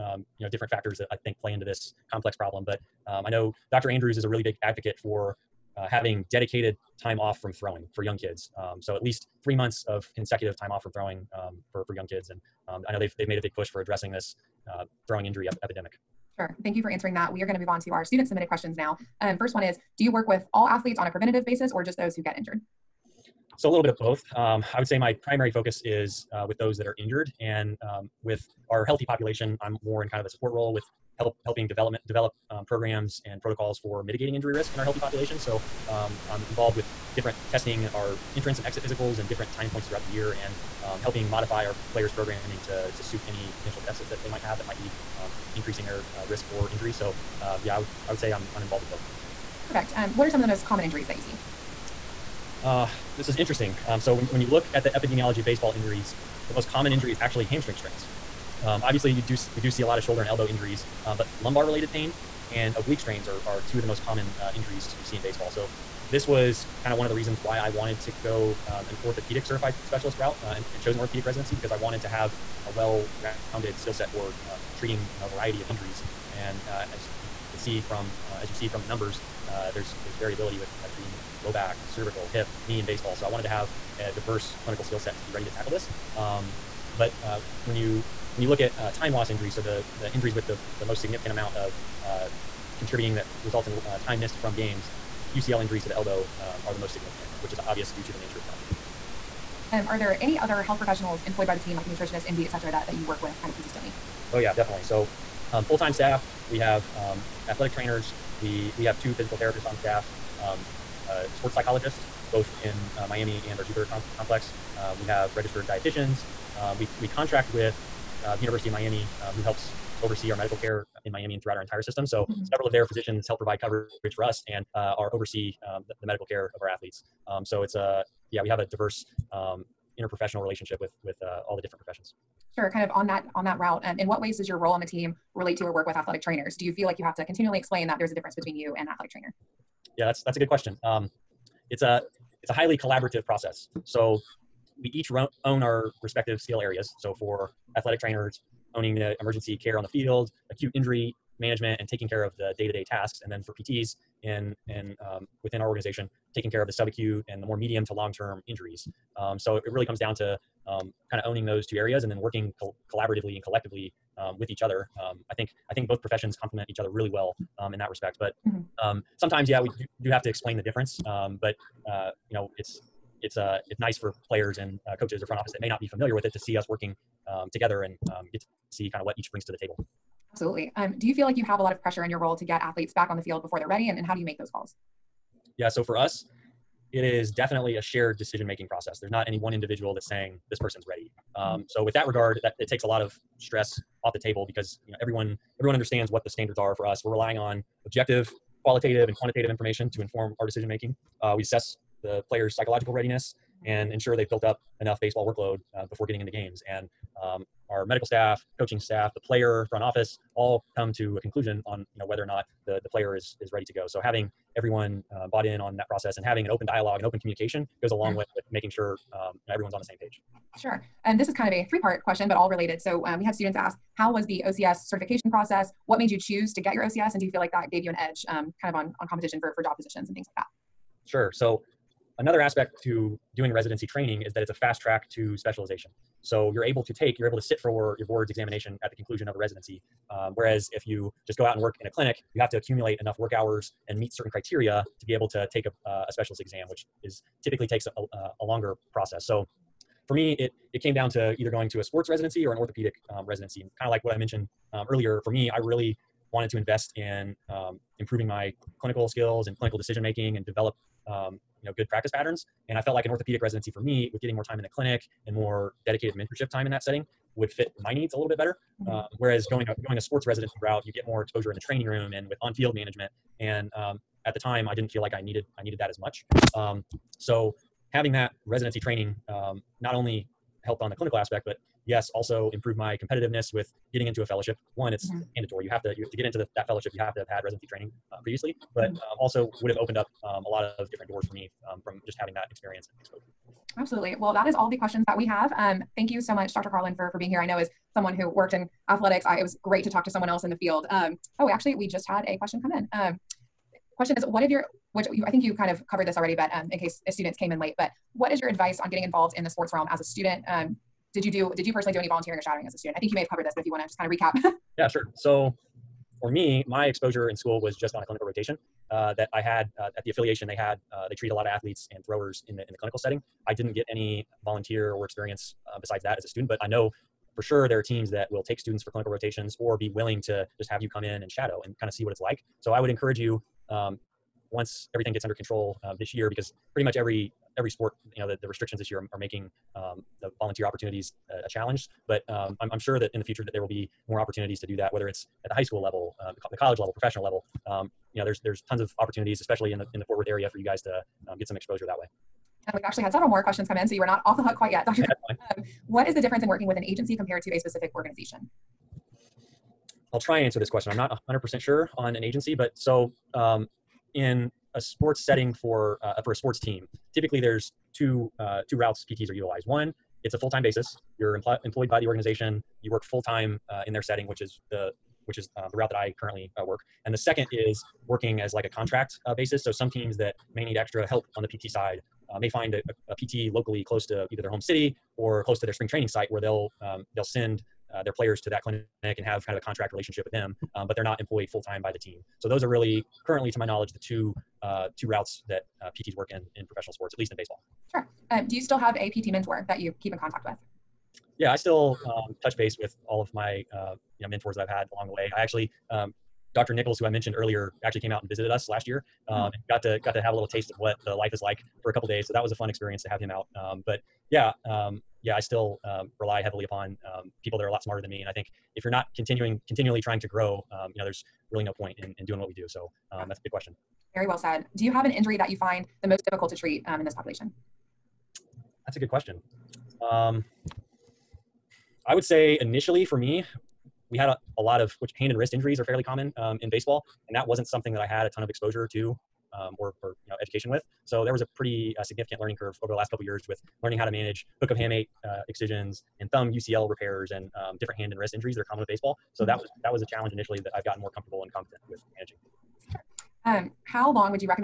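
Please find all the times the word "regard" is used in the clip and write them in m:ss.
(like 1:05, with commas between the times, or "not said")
3:12.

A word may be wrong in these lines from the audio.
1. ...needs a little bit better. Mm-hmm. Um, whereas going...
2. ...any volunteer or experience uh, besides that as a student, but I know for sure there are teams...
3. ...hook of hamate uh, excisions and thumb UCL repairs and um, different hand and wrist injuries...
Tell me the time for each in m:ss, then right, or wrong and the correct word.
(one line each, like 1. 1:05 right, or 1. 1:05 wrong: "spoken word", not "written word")
1. 4:27 right
2. 5:23 right
3. 7:24 right.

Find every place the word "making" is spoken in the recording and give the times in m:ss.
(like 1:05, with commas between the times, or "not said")
3:08, 3:20, 3:38, 4:20, 5:39.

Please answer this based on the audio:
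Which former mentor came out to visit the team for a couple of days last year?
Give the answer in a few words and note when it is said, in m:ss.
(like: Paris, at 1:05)
Dr. Nichols, at 6:46.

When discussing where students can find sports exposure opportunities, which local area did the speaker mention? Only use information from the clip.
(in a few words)
Fort Worth.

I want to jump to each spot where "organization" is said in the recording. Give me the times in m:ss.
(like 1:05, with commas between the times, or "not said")
2:35, 5:57, 6:12.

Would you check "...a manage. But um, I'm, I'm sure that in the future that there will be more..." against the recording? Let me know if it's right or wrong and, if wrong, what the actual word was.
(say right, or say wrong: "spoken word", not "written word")
wrong: "challenge", not "manage".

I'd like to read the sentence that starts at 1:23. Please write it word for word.
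So I wanted to have a diverse clinical skill set to be ready to tackle this.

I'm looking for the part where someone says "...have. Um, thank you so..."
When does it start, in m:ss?
4:55.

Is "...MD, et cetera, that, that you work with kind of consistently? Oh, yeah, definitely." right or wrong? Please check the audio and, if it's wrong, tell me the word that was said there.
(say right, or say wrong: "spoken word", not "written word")
right.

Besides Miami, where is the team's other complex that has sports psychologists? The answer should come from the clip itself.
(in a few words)
Jupiter.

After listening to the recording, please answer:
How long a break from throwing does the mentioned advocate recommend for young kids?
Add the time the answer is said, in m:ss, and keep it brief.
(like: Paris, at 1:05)
3 months, at 0:09.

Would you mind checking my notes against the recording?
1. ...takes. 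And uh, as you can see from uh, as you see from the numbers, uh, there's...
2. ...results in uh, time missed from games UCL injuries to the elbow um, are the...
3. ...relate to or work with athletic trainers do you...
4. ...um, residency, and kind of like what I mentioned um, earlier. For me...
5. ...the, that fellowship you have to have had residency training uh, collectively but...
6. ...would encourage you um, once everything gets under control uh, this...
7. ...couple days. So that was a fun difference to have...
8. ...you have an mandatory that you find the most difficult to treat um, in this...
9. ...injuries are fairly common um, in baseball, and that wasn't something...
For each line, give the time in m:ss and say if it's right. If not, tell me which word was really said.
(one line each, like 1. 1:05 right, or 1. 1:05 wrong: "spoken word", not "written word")
1. 1:15 wrong: "injuries", not "takes"
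2. 1:33 right
3. 2:15 right
4. 4:13 right
5. 4:46 wrong: "previously", not "collectively"
6. 5:32 right
7. 6:51 wrong: "experience", not "difference"
8. 7:04 wrong: "injury", not "mandatory"
9. 7:15 right.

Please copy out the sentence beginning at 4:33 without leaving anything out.
And um, at the time, I didn't feel like I needed I needed that as much.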